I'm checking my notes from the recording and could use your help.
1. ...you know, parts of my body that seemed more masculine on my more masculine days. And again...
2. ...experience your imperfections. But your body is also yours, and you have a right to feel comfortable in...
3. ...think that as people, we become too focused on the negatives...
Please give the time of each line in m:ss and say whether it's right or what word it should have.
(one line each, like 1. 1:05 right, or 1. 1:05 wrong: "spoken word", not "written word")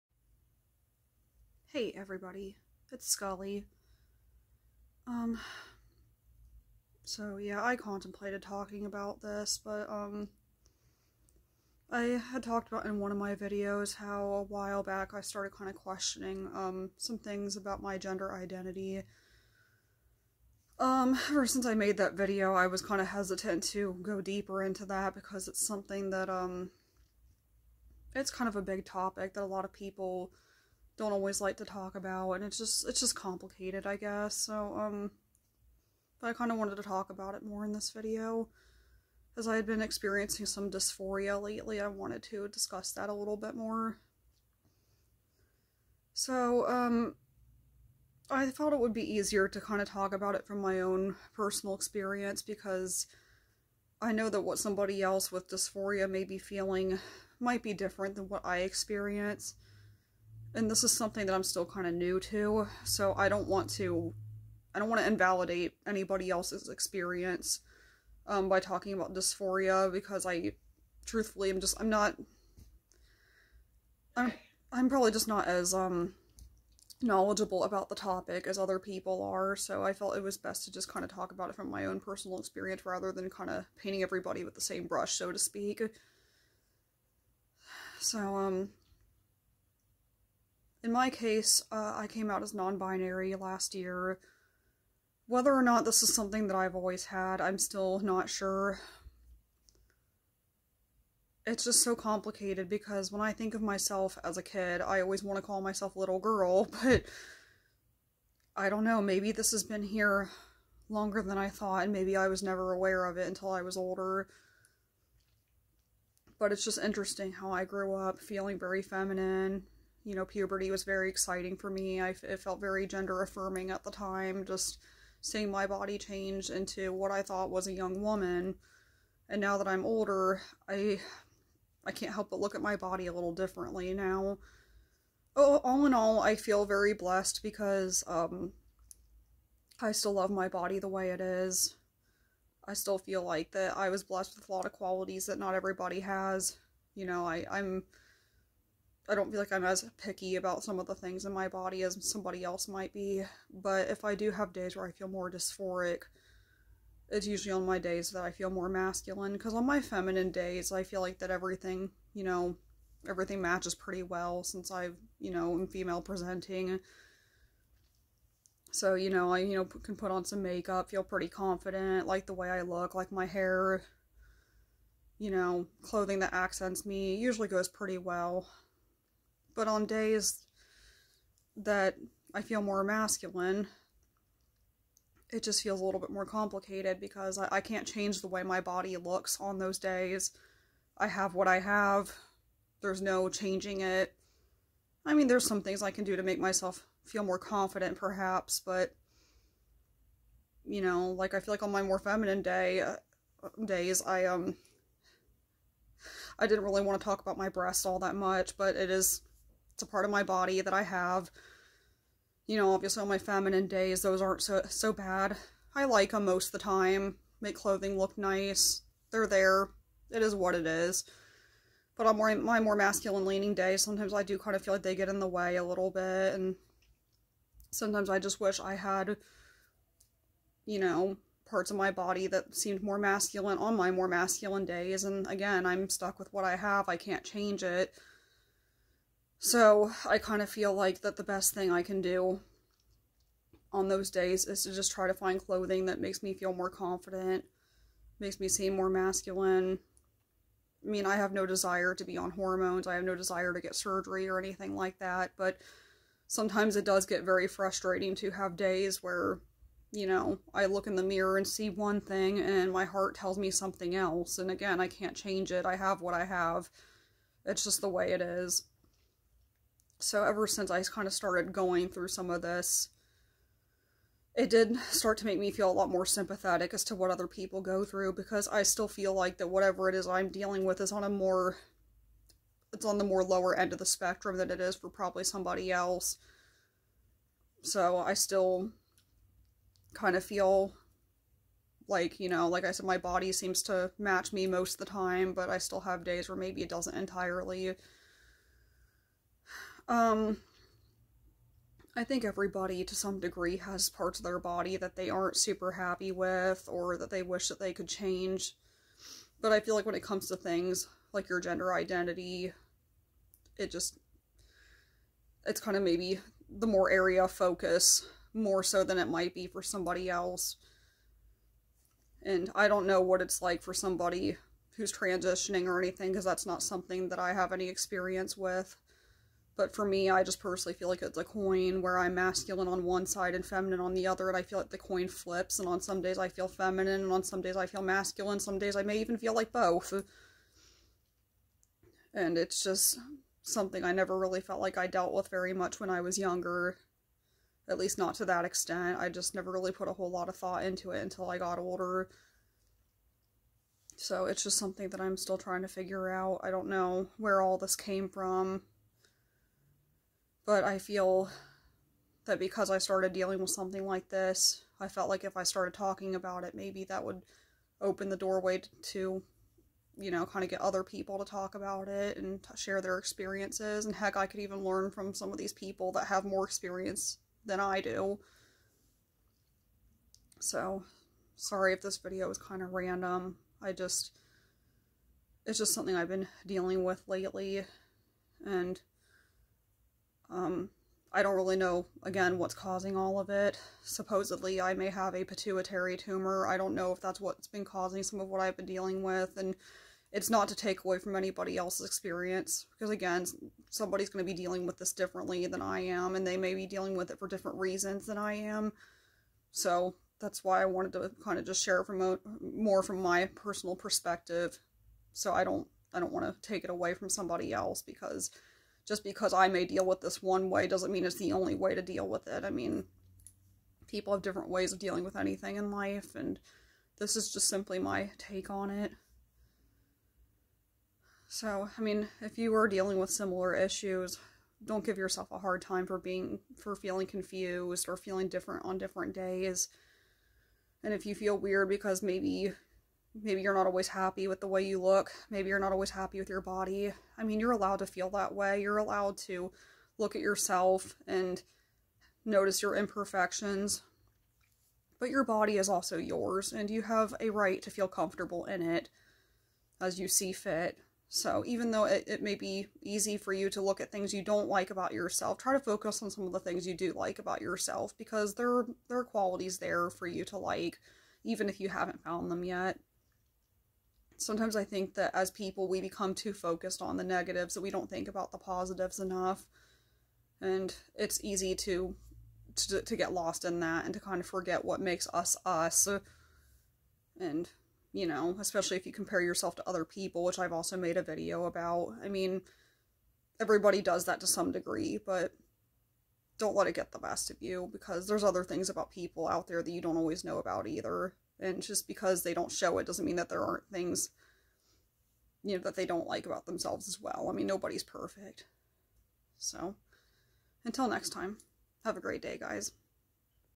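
1. 3:50 right
2. 7:32 wrong: "notice", not "experience"
3. 7:54 right.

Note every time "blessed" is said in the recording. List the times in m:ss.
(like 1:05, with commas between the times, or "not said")
2:16, 2:24.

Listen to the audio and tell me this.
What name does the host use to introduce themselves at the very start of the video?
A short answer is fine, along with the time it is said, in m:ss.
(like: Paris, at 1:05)
Skully, at 0:03.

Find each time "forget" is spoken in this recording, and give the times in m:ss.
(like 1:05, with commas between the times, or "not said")
8:04.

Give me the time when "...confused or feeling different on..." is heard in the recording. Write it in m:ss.
7:17.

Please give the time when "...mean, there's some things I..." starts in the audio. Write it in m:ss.
3:15.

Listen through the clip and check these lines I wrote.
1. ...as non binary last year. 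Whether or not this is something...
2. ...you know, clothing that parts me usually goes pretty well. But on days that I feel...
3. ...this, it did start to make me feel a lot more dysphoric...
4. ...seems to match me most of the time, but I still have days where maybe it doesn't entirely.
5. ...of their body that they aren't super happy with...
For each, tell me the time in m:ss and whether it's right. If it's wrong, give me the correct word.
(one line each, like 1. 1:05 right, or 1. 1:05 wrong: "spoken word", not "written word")
1. 1:32 right
2. 2:55 wrong: "accents", not "parts"
3. 4:32 wrong: "sympathetic", not "dysphoric"
4. 4:53 right
5. 5:04 right.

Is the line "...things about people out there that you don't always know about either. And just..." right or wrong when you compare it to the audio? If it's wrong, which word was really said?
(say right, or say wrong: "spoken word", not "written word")
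right.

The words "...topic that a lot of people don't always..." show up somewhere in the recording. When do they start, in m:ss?
0:28.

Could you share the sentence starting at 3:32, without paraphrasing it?
You know, obviously on my feminine days, those aren't so, so bad.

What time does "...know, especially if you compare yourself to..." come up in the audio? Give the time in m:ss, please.
8:08.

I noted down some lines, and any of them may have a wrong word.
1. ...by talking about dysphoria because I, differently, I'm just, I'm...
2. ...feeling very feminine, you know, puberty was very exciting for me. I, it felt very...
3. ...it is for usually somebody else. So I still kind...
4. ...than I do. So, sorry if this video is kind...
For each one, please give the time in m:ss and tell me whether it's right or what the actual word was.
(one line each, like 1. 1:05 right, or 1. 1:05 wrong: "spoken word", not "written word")
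1. 1:08 wrong: "truthfully", not "differently"
2. 1:58 right
3. 4:44 wrong: "probably", not "usually"
4. 6:17 right.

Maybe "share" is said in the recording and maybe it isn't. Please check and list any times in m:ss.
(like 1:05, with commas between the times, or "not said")
6:12, 6:51.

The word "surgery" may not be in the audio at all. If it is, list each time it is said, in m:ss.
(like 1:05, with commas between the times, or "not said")
4:13.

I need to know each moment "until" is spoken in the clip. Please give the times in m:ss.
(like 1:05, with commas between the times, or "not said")
1:53, 5:51, 8:30.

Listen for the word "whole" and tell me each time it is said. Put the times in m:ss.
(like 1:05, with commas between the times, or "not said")
5:49.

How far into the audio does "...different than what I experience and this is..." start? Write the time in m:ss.
0:57.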